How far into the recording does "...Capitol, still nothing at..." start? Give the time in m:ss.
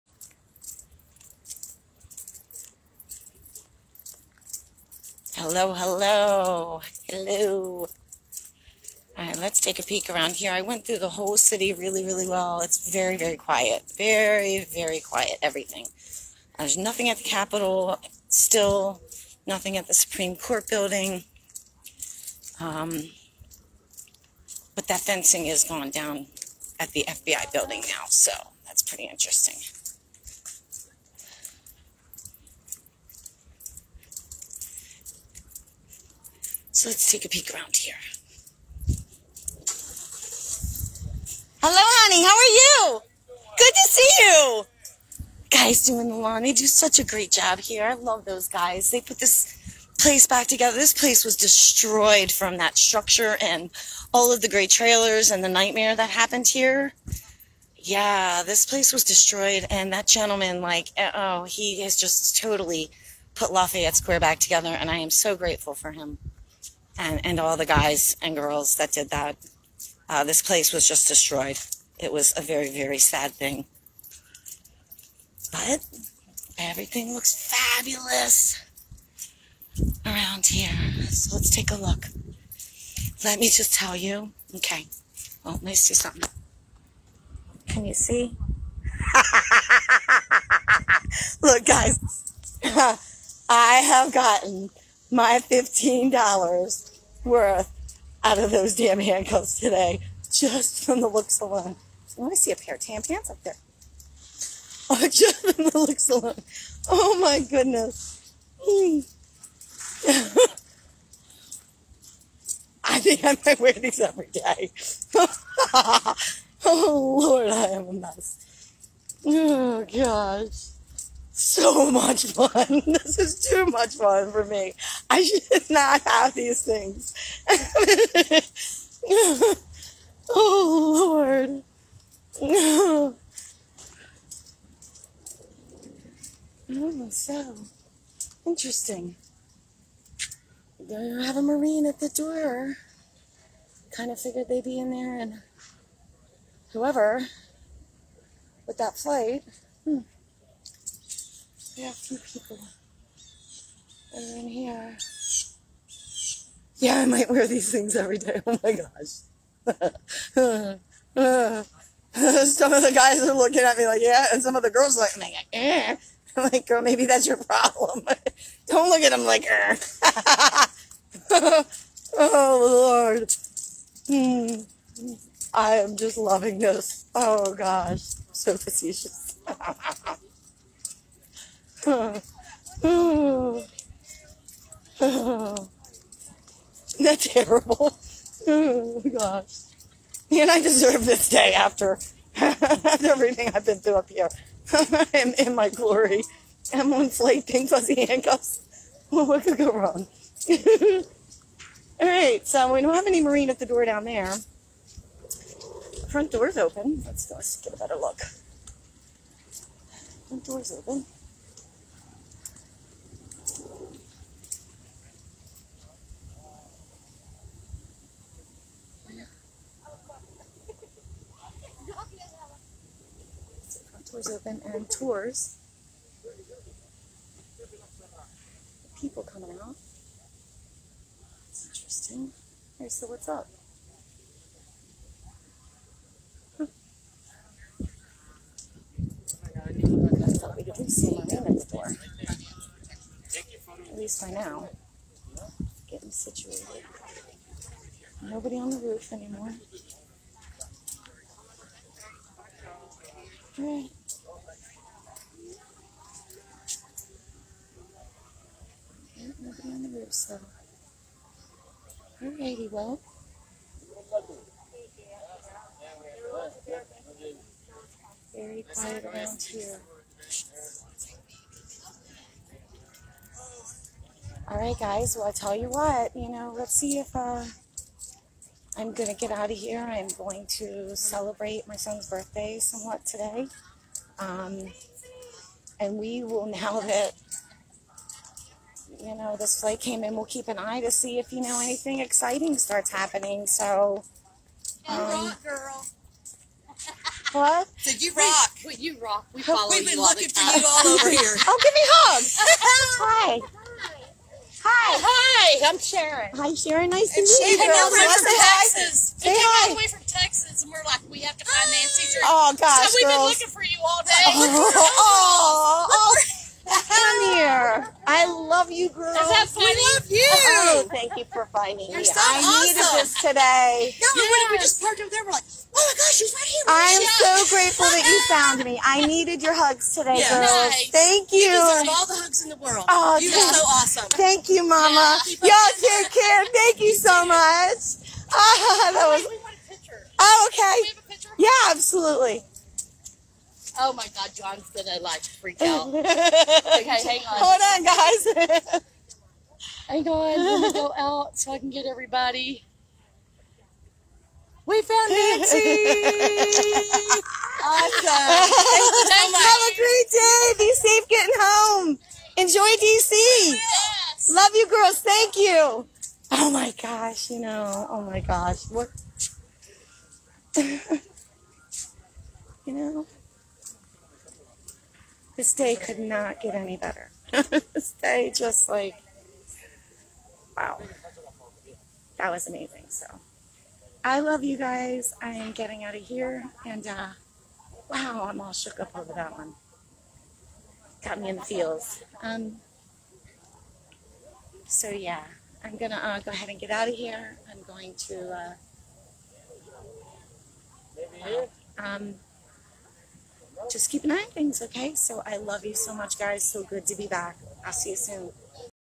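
0:17.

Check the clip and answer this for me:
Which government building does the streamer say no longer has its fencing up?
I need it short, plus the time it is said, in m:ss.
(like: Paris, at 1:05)
FBI building, at 0:27.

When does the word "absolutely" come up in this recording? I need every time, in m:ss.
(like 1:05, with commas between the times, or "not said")
5:41.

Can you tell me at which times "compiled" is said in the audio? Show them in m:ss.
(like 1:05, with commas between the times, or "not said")
not said.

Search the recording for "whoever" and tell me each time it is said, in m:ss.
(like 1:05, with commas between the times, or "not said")
2:26.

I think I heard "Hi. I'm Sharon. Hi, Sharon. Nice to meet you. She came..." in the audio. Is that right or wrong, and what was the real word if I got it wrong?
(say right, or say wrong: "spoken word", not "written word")
right.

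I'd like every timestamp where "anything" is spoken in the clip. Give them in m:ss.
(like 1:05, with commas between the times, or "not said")
4:51.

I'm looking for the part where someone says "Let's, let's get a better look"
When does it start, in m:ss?
3:27.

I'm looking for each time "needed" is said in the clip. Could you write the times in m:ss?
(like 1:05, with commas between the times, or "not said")
5:22, 5:29.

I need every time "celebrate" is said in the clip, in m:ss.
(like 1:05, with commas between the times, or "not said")
4:40.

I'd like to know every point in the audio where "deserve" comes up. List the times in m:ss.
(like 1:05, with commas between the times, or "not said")
3:10, 5:31.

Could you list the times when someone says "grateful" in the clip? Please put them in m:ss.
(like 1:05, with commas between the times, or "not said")
1:05, 5:27.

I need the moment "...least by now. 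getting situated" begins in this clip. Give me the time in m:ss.
4:03.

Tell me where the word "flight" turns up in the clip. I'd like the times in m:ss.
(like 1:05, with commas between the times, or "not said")
2:28, 4:49.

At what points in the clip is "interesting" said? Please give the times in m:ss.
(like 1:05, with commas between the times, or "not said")
0:29, 2:18, 3:51.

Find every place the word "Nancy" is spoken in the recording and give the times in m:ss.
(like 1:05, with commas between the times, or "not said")
5:11, 5:55.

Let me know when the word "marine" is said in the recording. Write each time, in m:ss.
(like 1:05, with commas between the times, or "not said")
2:21, 3:23.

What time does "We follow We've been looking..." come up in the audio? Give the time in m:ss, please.
4:59.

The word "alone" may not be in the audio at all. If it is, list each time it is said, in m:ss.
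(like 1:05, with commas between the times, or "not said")
1:41, 1:46.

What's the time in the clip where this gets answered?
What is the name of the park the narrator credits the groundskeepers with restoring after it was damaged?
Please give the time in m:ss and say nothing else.
1:03.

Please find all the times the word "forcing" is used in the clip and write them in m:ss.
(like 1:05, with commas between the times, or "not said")
not said.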